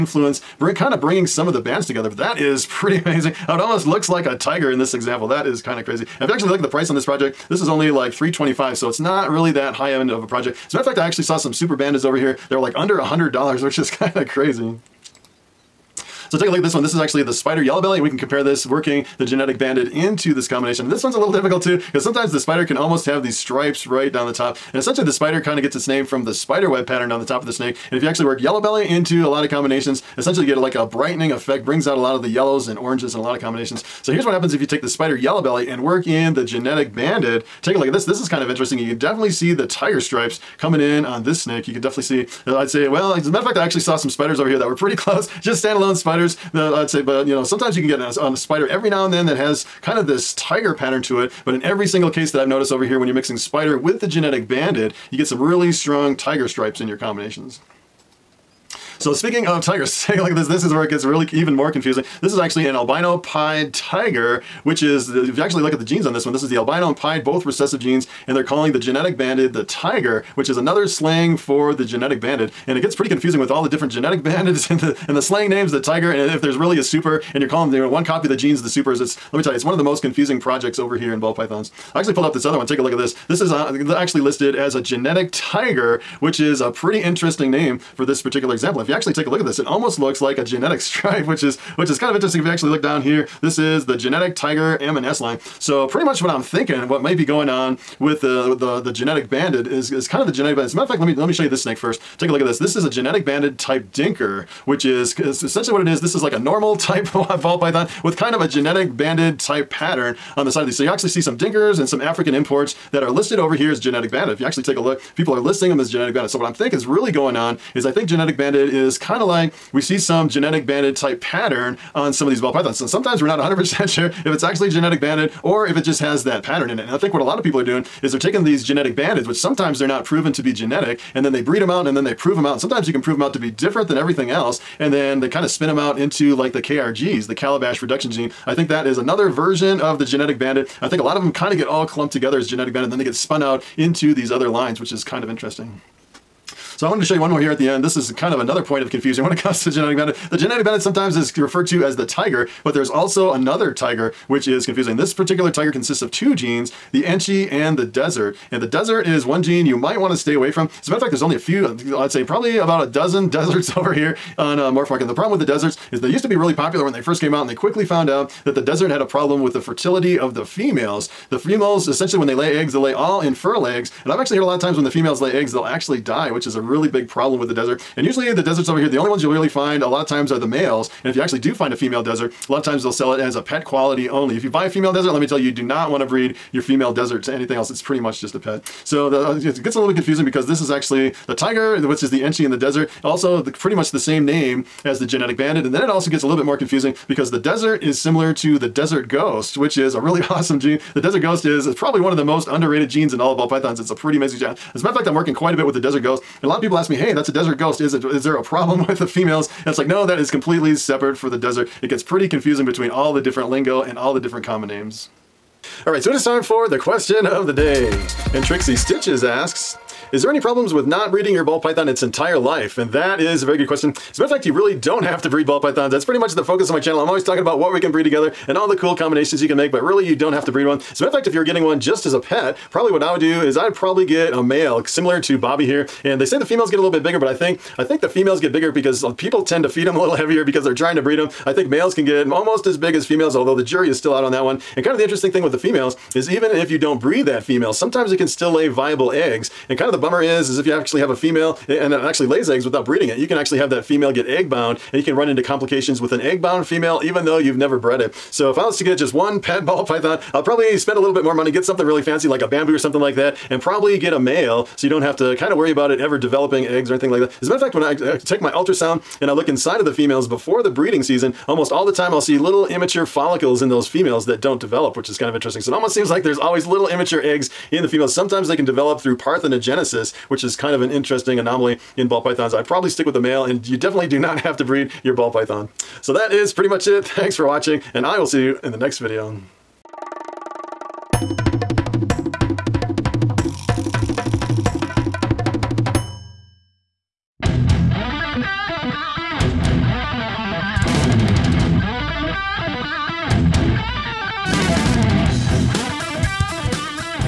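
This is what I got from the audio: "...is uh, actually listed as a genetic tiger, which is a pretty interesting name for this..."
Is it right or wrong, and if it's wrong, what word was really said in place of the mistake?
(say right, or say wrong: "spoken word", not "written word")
right.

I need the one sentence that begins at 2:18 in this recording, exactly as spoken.
I think that is another version of the genetic banded.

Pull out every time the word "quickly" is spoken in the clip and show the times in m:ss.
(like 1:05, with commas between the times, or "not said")
2:47.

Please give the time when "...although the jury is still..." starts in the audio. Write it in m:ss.
4:03.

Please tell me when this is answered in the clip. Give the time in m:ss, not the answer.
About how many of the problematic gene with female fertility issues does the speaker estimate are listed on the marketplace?
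2:42.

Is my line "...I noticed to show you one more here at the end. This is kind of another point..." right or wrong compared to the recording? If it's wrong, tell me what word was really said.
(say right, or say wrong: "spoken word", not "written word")
wrong: "wanted", not "noticed".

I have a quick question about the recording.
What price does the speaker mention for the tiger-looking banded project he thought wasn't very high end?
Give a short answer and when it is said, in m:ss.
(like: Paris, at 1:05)
325, at 0:08.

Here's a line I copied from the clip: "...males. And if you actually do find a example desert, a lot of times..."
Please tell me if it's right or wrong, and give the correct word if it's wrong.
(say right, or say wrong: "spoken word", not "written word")
wrong: "female", not "example".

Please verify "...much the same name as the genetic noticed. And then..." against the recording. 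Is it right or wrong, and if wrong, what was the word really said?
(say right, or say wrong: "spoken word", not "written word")
wrong: "banded", not "noticed".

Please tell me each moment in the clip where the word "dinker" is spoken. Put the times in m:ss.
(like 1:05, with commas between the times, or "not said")
1:43, 1:51.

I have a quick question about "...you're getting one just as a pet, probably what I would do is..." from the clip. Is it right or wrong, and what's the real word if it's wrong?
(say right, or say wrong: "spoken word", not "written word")
right.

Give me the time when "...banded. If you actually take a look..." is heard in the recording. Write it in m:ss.
1:54.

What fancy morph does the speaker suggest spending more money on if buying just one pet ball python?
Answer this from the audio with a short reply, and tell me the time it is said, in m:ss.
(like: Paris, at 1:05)
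bamboo, at 4:22.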